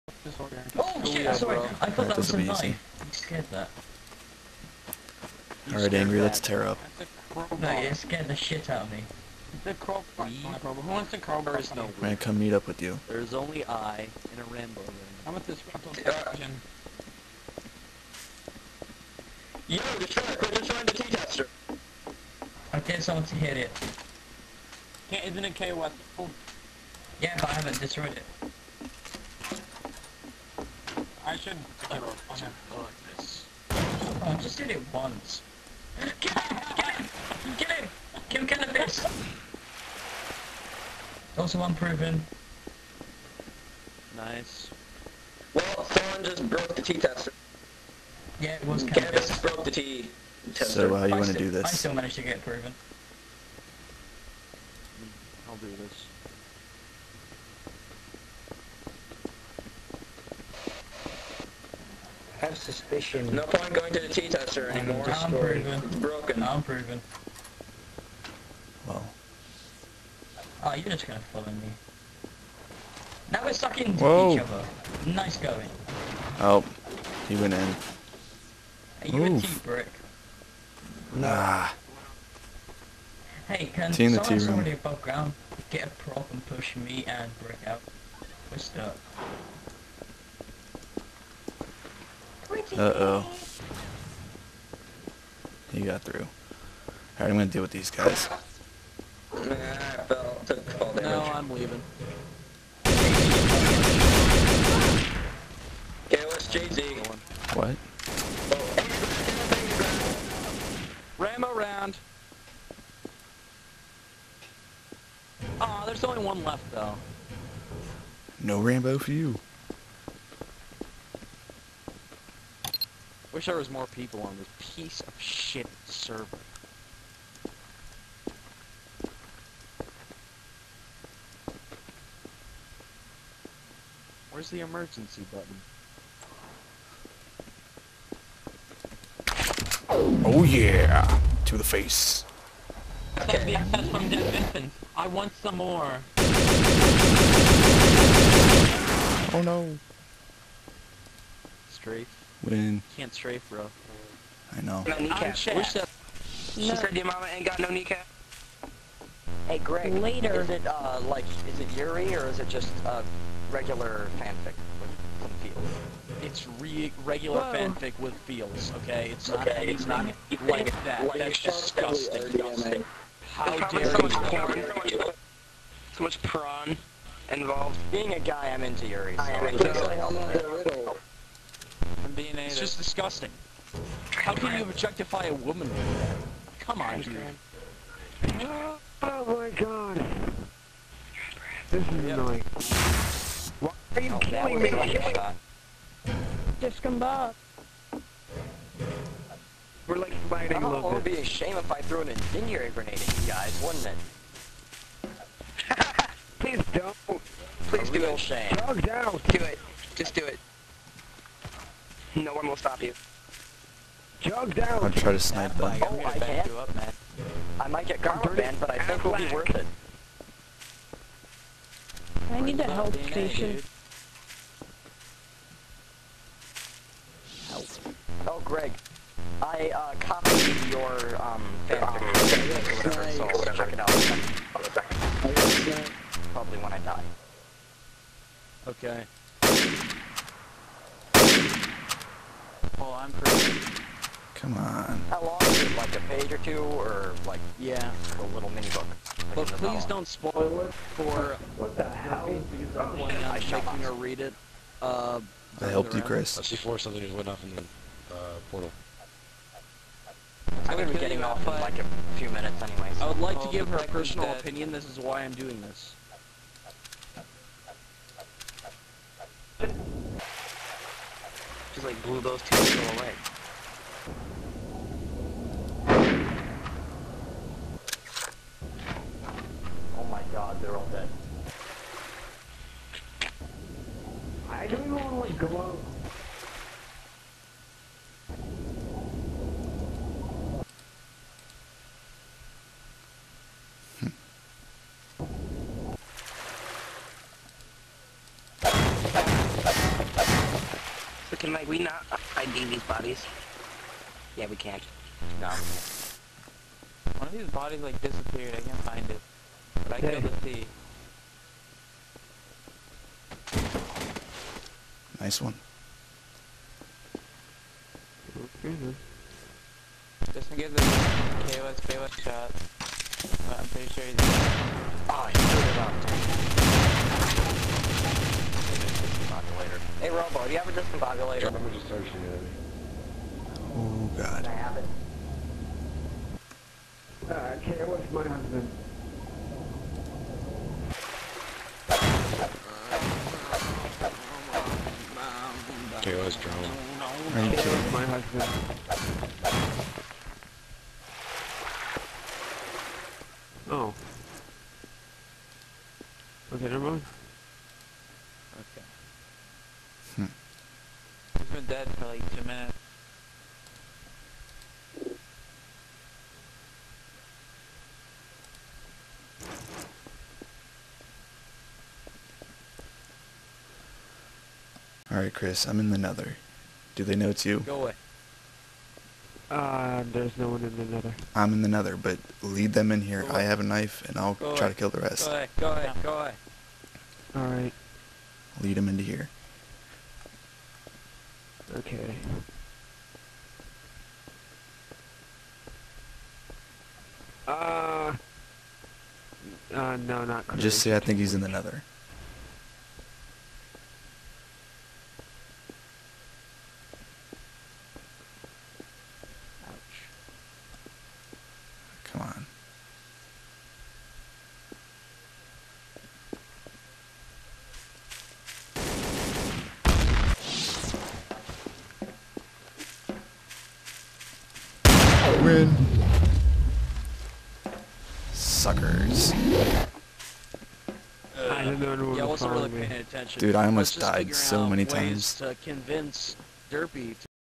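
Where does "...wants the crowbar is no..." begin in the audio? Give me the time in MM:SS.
00:10.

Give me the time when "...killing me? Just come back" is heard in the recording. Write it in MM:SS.
03:14.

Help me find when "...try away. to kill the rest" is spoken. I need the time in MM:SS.
06:24.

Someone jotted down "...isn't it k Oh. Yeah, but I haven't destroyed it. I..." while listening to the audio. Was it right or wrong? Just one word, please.
right.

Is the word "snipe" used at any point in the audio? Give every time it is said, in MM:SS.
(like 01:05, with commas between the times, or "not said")
03:35.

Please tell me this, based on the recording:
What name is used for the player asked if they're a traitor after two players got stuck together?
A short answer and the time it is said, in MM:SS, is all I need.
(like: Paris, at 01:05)
Brick, at 01:19.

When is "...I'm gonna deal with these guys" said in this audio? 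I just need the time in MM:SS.
01:37.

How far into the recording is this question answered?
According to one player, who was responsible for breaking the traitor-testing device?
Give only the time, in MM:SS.
00:49.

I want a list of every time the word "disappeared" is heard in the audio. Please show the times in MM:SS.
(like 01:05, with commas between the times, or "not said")
05:08.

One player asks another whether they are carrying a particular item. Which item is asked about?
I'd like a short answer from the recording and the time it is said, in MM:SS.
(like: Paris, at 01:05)
Discombobulator, at 05:30.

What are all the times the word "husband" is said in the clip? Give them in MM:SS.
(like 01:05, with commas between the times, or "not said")
05:38, 05:48.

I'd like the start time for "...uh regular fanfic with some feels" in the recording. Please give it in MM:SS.
02:42.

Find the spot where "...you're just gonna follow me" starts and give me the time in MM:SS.
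01:10.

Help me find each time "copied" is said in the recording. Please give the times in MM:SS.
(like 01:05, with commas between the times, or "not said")
03:49.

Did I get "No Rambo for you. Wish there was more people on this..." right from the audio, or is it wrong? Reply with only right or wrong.
right.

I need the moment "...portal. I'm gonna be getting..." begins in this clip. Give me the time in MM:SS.
04:18.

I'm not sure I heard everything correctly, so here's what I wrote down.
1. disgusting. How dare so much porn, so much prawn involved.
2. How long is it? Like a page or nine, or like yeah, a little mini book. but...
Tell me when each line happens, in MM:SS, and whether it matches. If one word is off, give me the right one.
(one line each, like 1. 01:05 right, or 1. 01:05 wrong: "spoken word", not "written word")
1. 02:52 right
2. 04:05 wrong: "two", not "nine".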